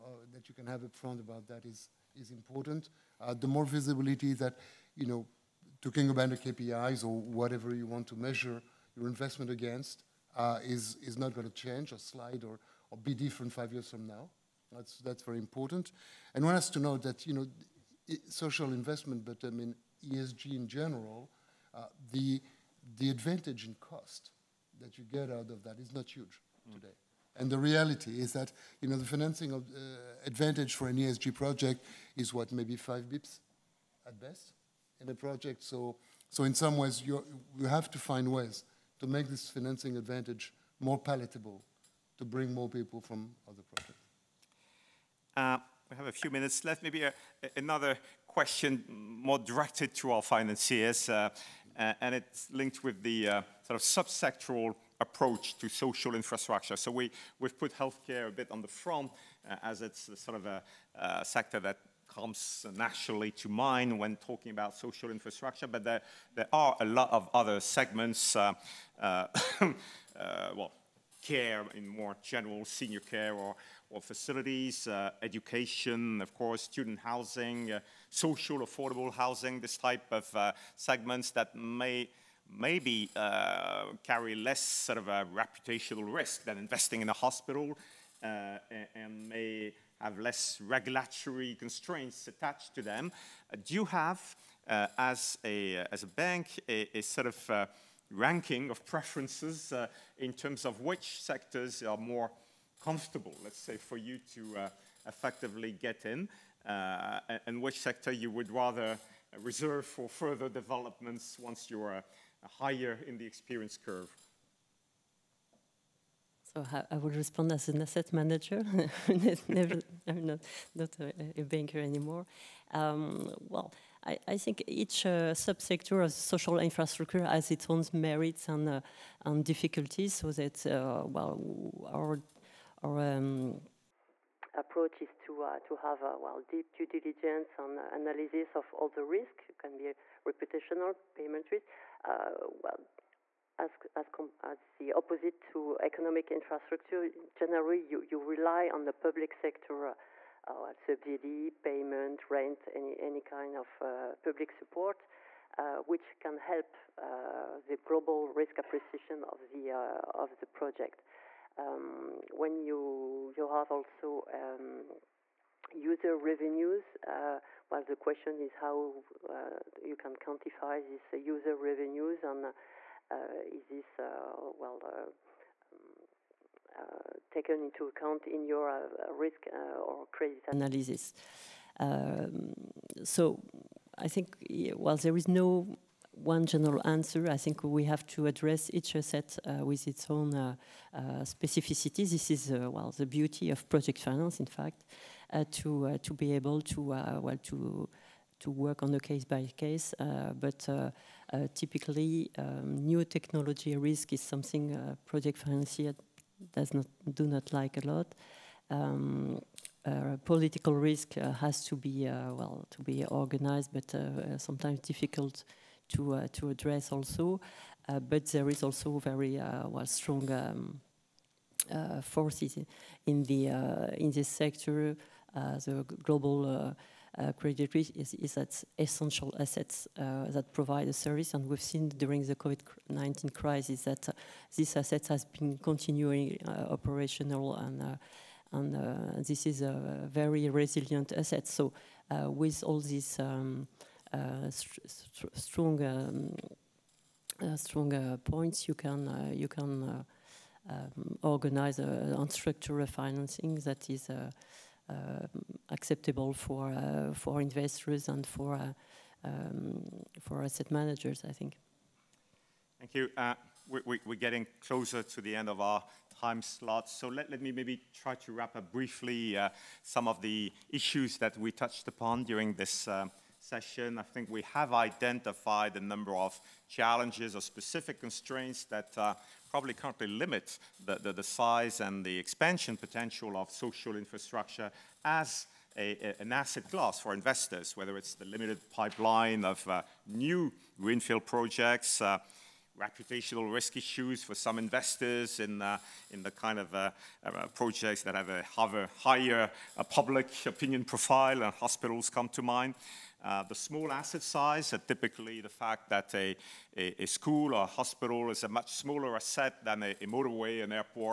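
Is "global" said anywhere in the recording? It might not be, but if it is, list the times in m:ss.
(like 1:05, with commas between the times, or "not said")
2:37, 3:46.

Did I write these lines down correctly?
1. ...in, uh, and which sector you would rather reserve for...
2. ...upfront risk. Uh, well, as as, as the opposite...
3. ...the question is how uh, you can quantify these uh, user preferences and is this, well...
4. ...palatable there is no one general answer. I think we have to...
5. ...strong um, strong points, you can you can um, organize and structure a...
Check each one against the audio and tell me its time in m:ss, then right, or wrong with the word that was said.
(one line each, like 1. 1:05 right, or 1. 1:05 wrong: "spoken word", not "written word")
1. 1:46 right
2. 2:21 wrong: "payment", not "upfront"
3. 2:47 wrong: "revenues", not "preferences"
4. 3:04 wrong: "while", not "palatable"
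5. 4:05 right.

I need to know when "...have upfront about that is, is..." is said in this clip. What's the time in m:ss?
0:00.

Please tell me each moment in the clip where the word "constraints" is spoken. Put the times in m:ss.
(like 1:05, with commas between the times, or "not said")
1:31, 4:38.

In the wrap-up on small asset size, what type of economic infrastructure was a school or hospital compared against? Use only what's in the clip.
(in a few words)
A motorway.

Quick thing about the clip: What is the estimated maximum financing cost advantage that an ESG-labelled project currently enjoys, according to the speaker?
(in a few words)
5 bps.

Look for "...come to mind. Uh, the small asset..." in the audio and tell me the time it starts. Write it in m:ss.
5:02.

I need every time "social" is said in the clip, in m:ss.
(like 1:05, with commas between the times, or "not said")
0:18, 0:55, 1:04, 1:18, 2:06, 4:43.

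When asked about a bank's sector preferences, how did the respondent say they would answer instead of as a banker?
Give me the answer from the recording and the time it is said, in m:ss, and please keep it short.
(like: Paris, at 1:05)
As an asset manager, at 1:57.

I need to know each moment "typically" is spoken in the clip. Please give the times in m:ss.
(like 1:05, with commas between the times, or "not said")
3:21, 5:04.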